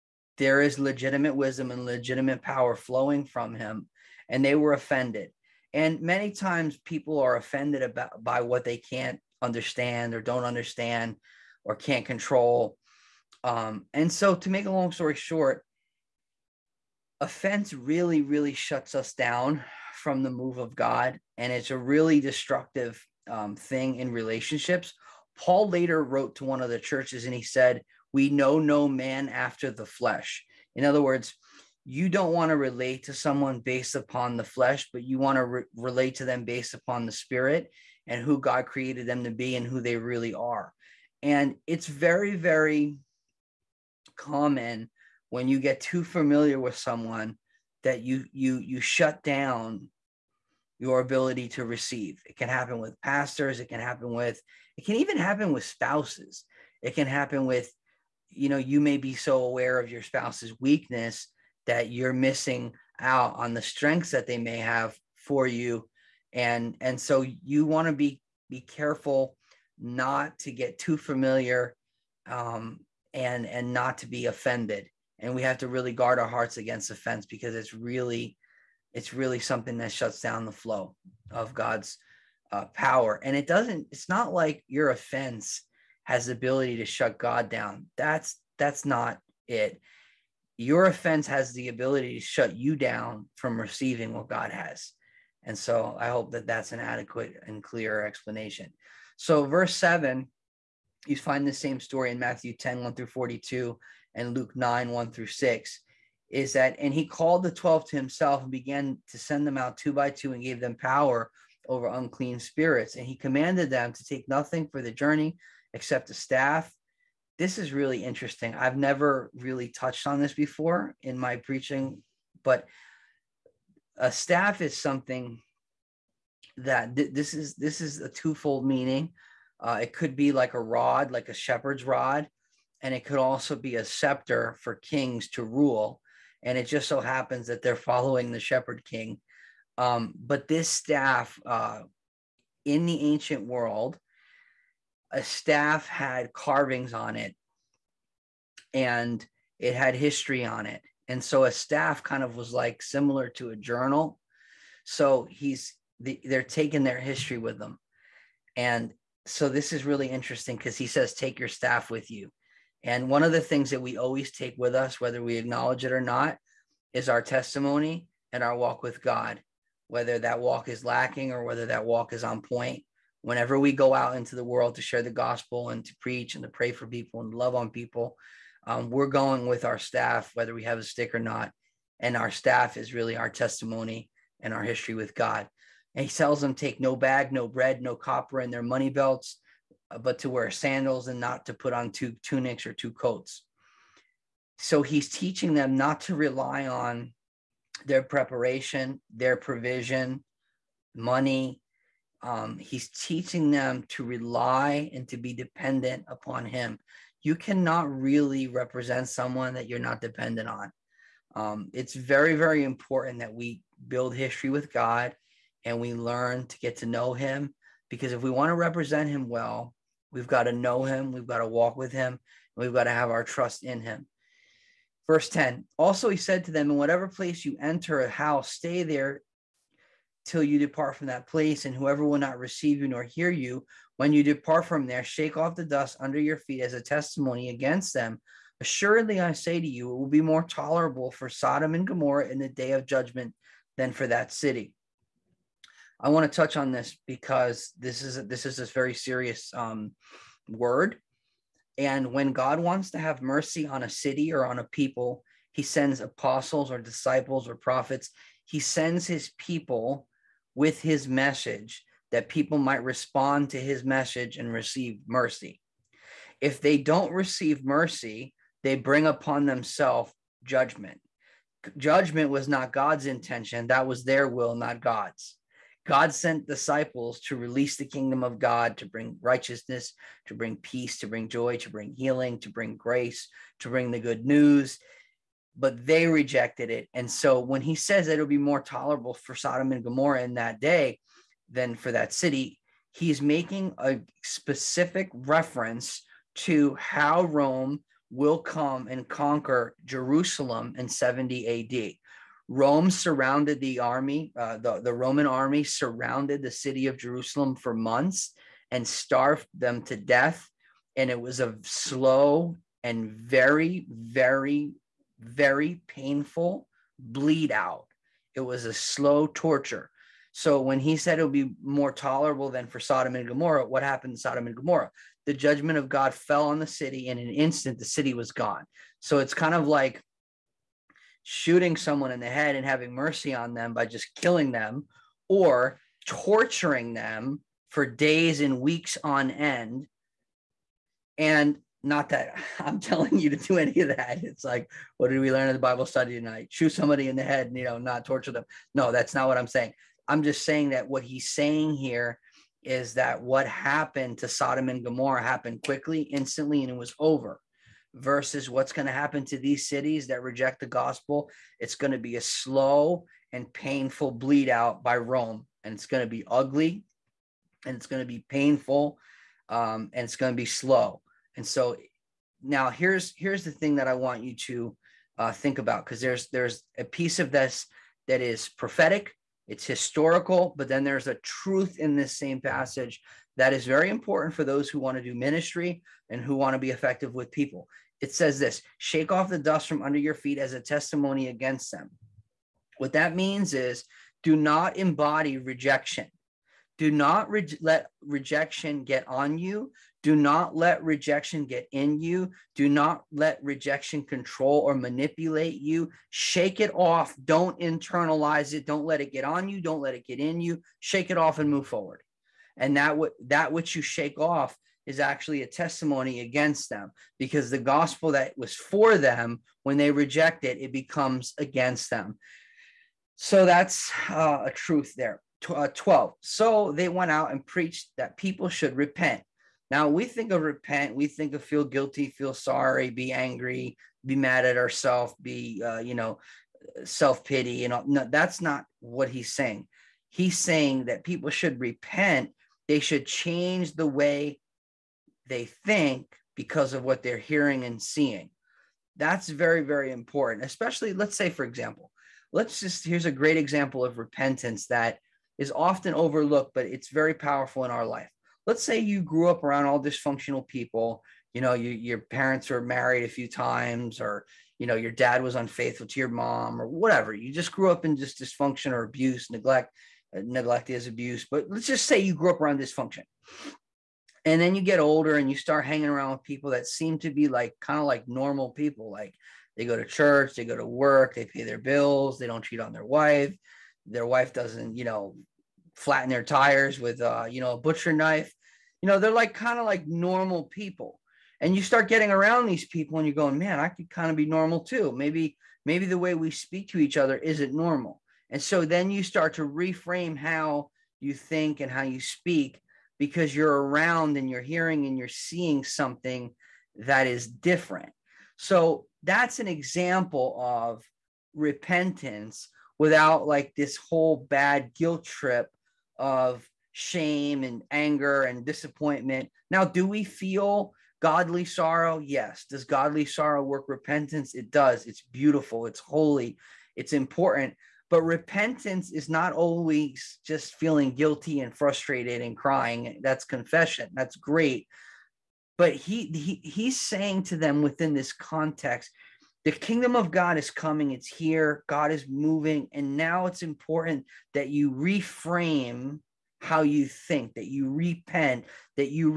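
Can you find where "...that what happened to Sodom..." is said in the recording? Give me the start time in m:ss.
5:52.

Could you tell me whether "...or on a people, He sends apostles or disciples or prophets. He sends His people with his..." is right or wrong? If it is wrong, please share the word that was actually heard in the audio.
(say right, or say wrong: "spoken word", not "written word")
right.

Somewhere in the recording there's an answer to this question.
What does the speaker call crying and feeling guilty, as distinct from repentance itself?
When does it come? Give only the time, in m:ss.
8:53.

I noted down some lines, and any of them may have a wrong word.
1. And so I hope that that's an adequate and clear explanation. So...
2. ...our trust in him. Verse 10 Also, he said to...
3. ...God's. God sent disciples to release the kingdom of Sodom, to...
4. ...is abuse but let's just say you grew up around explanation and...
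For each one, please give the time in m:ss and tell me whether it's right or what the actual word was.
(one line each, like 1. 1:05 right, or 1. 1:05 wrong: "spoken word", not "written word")
1. 1:35 right
2. 3:43 right
3. 4:34 wrong: "God", not "Sodom"
4. 7:50 wrong: "dysfunction", not "explanation".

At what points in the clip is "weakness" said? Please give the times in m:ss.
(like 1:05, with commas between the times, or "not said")
1:00.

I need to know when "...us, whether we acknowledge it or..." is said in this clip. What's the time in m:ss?
2:44.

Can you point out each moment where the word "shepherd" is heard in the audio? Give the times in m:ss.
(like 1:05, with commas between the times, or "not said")
2:11, 2:18.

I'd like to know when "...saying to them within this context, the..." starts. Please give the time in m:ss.
8:56.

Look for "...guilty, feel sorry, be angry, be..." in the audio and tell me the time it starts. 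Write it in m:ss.
7:11.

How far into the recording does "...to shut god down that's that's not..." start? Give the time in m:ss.
1:26.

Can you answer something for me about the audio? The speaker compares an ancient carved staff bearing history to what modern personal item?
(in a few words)
a journal.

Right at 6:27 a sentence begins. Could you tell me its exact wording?
It says this shake off the dust from under your feet as a testimony against them.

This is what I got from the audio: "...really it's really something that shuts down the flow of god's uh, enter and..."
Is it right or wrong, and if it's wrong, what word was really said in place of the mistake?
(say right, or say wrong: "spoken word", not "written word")
wrong: "power", not "enter".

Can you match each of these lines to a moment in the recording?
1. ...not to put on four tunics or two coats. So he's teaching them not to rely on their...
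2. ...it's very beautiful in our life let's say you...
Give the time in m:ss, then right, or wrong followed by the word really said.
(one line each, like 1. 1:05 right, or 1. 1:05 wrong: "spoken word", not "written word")
1. 3:11 wrong: "two", not "four"
2. 7:36 wrong: "powerful", not "beautiful".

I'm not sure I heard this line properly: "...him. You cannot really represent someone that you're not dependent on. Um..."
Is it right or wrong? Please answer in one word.
right.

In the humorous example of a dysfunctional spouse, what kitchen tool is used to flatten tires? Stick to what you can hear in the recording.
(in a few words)
a butcher knife.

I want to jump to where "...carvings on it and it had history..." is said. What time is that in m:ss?
2:26.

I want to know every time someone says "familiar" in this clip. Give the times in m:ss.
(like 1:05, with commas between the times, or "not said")
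0:46, 1:10.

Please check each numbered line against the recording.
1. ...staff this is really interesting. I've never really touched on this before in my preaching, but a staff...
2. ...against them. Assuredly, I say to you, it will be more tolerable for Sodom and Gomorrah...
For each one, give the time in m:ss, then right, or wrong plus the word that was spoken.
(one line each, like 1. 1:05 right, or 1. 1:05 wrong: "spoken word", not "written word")
1. 1:56 right
2. 3:57 right.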